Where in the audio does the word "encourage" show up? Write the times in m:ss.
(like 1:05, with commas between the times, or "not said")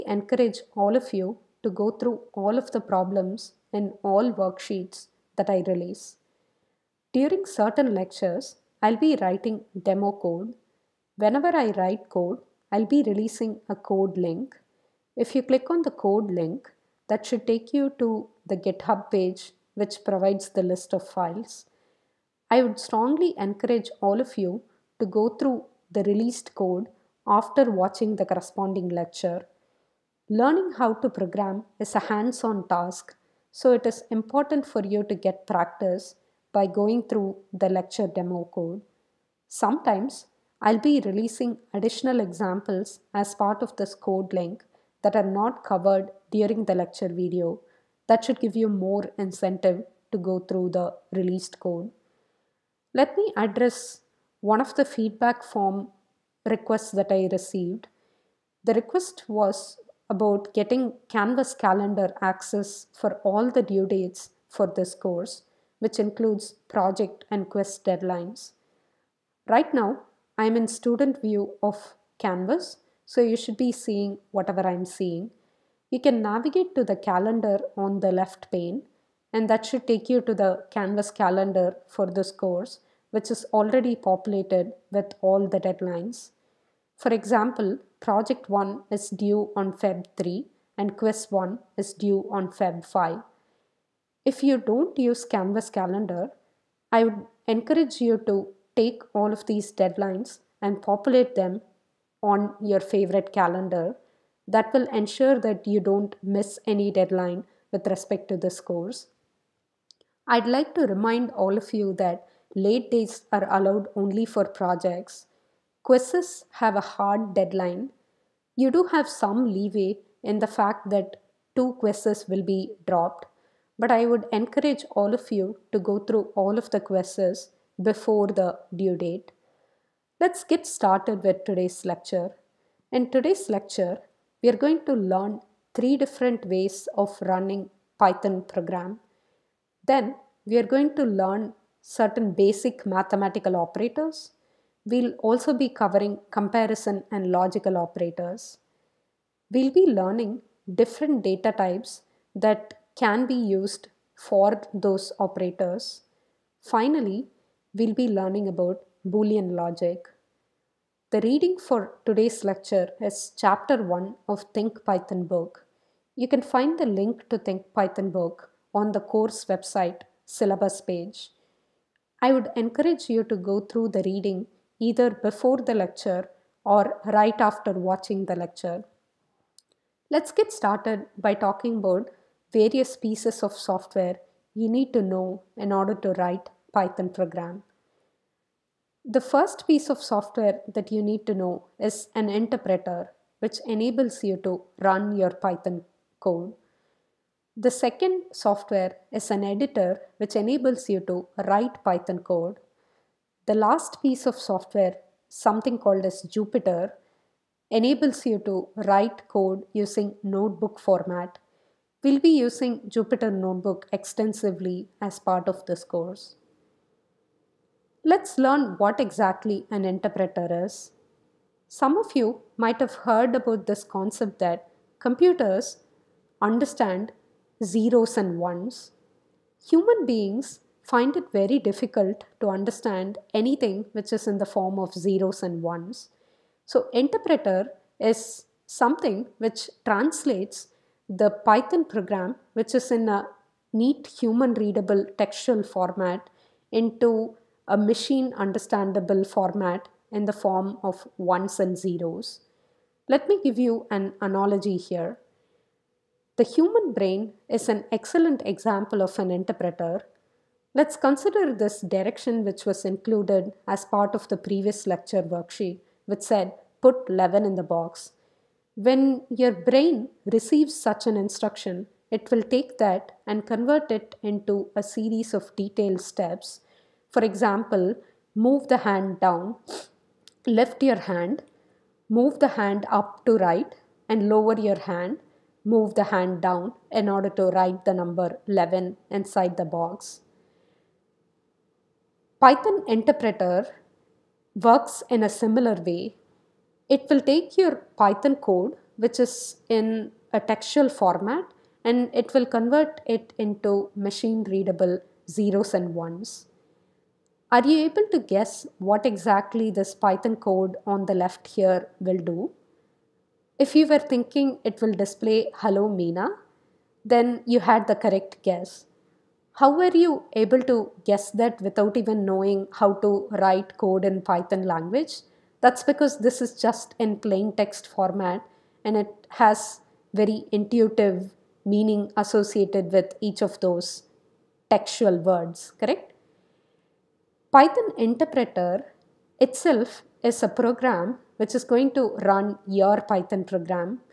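0:00, 0:23, 1:37, 2:04, 2:52.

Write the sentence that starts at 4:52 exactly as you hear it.
Python interpreter works in a similar way.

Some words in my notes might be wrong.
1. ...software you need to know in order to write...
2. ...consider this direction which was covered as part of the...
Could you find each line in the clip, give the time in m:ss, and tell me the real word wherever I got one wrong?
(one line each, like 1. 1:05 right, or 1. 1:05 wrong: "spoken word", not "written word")
1. 3:03 right
2. 4:20 wrong: "included", not "covered".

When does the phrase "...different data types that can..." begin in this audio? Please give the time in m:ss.
2:30.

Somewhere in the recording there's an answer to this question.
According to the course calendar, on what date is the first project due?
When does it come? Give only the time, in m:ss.
1:29.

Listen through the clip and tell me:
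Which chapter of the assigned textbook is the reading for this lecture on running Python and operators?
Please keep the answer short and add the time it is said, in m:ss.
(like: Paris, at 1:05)
Chapter 1, at 2:43.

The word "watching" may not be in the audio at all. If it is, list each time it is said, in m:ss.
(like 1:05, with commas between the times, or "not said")
0:27, 2:57.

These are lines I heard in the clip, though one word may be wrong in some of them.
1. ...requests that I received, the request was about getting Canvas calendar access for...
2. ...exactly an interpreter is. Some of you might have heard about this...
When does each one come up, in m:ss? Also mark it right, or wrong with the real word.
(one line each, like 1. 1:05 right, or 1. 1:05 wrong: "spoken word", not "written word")
1. 0:56 right
2. 3:39 right.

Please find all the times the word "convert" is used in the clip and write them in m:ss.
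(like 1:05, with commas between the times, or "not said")
4:33, 5:02.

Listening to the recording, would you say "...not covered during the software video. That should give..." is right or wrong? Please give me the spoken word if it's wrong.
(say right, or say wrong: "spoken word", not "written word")
wrong: "lecture", not "software".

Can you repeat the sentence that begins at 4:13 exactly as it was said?
Let me give you an analogy here.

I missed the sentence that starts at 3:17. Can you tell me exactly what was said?
The second software is an editor which enables you to write Python code.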